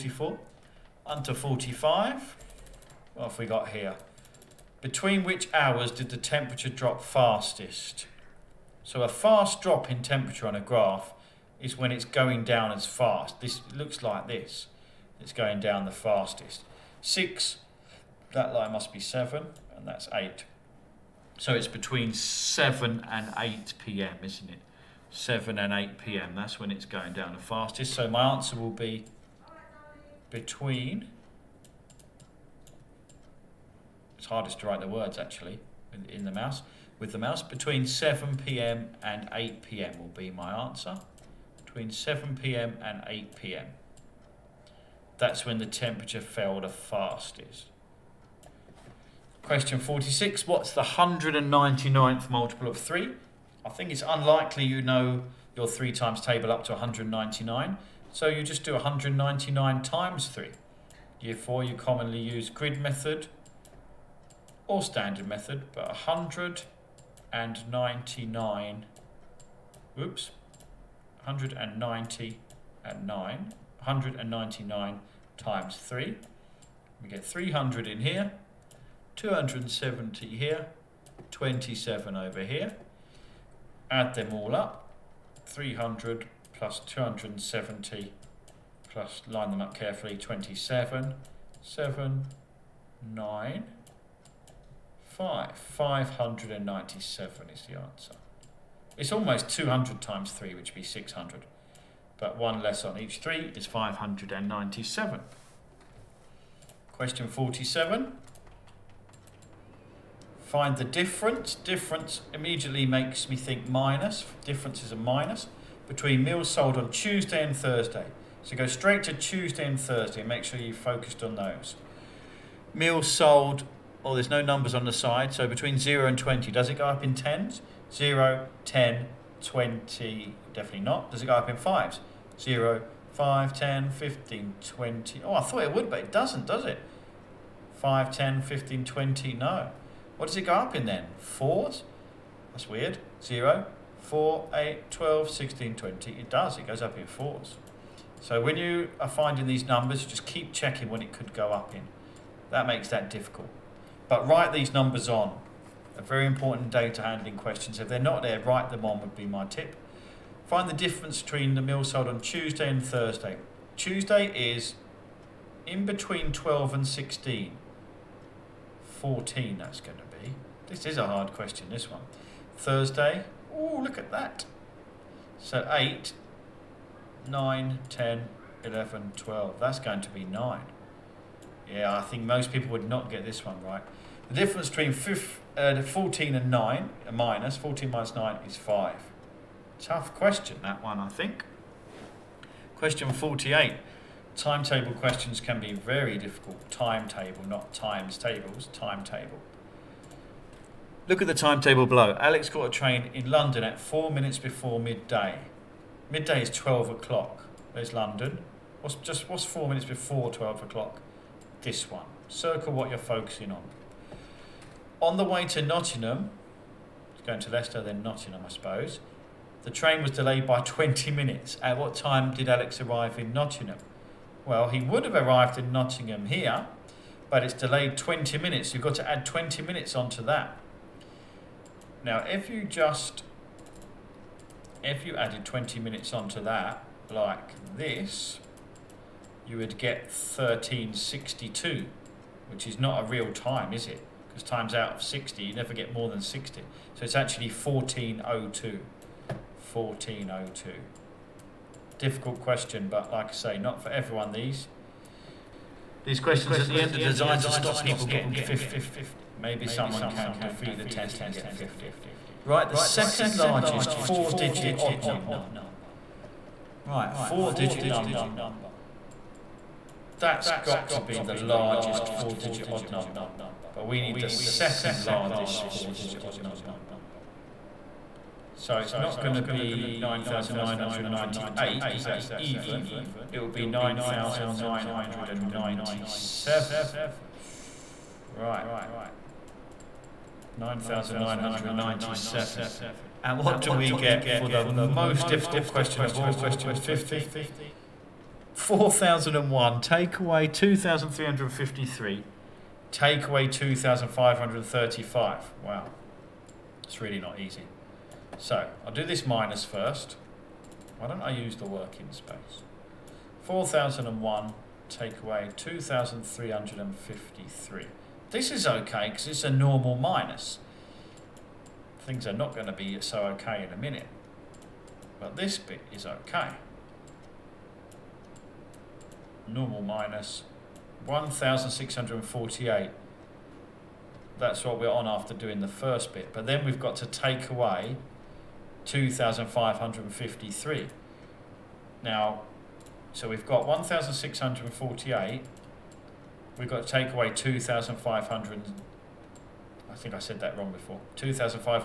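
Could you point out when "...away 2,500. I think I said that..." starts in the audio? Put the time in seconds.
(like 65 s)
347 s.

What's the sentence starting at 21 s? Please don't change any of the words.
So it's between 7 and 8 p.m., isn't it?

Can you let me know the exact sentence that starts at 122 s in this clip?
Meals sold, well, there's no numbers on the side, so between 0 and 20, does it go up in tens?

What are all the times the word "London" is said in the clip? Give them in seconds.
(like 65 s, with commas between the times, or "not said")
203 s, 207 s.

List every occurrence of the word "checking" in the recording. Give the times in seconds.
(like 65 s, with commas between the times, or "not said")
150 s.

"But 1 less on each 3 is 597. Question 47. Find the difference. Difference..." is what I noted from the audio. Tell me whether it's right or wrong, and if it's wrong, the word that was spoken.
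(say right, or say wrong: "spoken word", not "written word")
right.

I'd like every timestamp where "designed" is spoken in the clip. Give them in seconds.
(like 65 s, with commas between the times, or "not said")
256 s.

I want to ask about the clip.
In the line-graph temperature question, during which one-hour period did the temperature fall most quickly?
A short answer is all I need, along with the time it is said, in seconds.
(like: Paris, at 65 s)
7pm and 8pm, at 37 s.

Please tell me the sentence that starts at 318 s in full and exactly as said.
This is okay because it's a normal minus.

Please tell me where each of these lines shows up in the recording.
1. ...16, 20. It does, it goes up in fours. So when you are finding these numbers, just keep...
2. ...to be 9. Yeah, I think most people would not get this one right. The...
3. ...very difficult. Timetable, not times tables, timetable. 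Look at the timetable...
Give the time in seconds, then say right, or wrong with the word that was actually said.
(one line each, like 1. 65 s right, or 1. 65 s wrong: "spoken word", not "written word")
1. 145 s right
2. 180 s right
3. 195 s right.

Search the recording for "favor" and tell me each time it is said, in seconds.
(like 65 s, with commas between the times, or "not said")
not said.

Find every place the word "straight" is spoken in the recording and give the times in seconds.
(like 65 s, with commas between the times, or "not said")
118 s.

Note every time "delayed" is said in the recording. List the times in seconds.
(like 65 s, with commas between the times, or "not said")
220 s, 227 s.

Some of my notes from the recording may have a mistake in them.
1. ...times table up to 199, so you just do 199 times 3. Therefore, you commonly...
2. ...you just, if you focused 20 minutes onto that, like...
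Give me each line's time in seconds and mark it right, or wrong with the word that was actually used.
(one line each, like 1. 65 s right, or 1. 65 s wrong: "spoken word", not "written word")
1. 55 s right
2. 232 s wrong: "added", not "focused".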